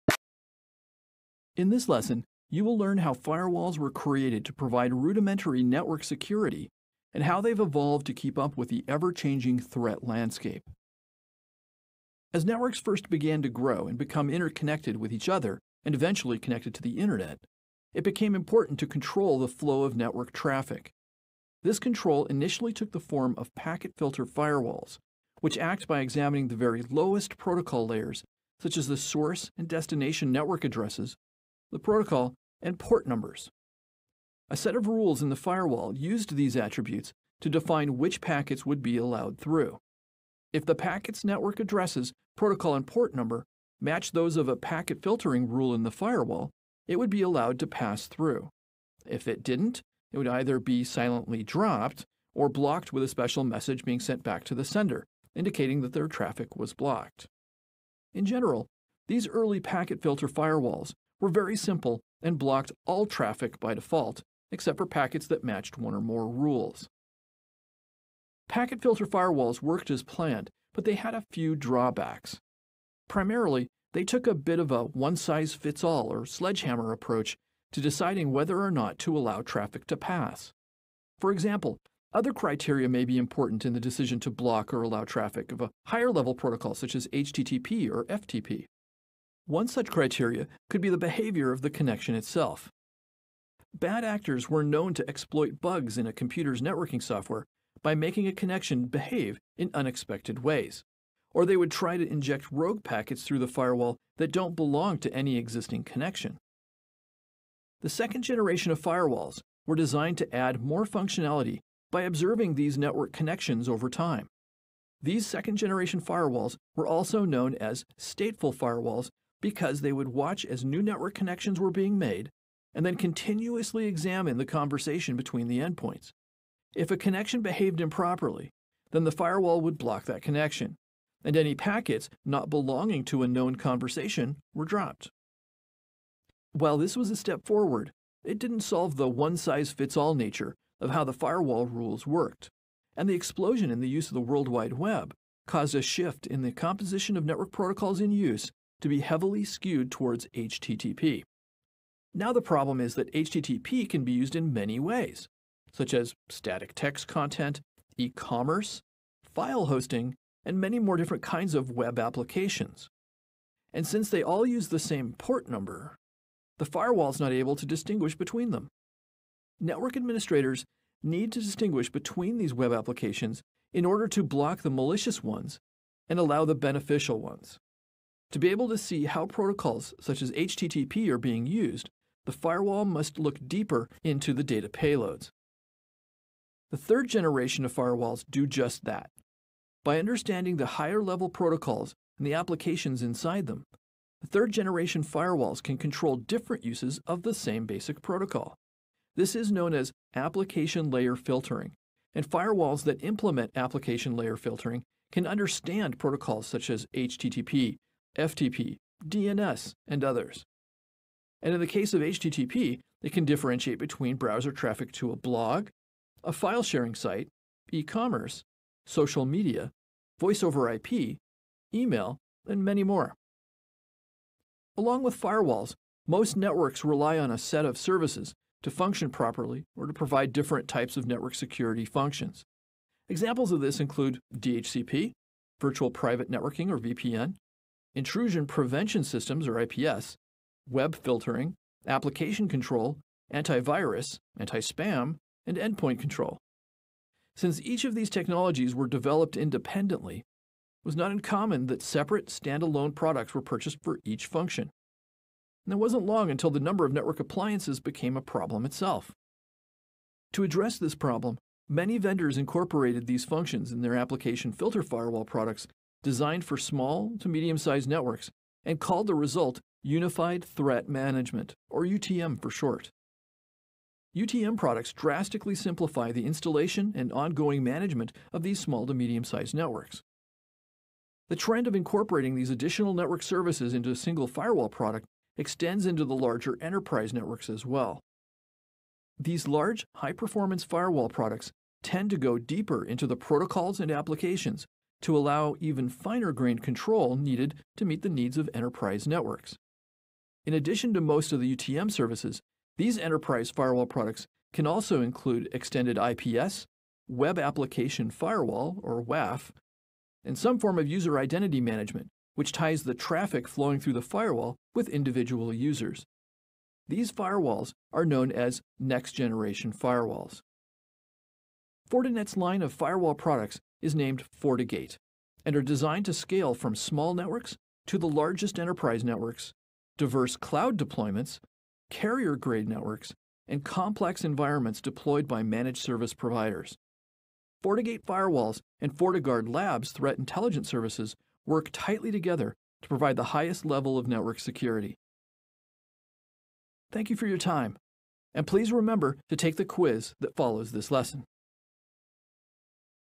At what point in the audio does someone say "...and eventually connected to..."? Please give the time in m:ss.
0:15.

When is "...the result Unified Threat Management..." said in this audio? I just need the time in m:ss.
4:29.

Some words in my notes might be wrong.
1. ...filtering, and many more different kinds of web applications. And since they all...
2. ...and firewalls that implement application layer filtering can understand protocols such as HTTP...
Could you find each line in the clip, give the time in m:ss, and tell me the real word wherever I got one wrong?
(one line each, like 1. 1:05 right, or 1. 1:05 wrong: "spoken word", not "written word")
1. 2:39 wrong: "hosting", not "filtering"
2. 3:22 right.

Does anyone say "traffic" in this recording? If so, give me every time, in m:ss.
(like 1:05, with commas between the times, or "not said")
0:20, 0:56, 1:03, 1:19, 1:25, 3:34, 5:12.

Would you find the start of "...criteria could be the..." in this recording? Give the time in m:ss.
1:29.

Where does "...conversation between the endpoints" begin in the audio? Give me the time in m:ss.
2:04.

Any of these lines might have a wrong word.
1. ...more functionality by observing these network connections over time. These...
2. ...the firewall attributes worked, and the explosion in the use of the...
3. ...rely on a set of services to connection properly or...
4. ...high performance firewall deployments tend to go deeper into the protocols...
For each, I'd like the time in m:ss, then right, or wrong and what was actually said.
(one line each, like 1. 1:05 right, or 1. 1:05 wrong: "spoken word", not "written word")
1. 1:50 right
2. 2:21 wrong: "rules", not "attributes"
3. 3:46 wrong: "function", not "connection"
4. 4:49 wrong: "products", not "deployments".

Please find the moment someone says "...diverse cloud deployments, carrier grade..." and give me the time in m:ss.
5:29.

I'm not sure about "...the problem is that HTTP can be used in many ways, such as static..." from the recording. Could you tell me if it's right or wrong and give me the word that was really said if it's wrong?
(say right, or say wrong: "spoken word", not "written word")
right.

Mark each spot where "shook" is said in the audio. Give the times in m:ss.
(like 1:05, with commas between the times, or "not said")
not said.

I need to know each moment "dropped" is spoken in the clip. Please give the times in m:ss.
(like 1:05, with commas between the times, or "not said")
0:51, 2:14.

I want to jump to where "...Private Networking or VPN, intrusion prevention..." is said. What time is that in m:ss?
3:55.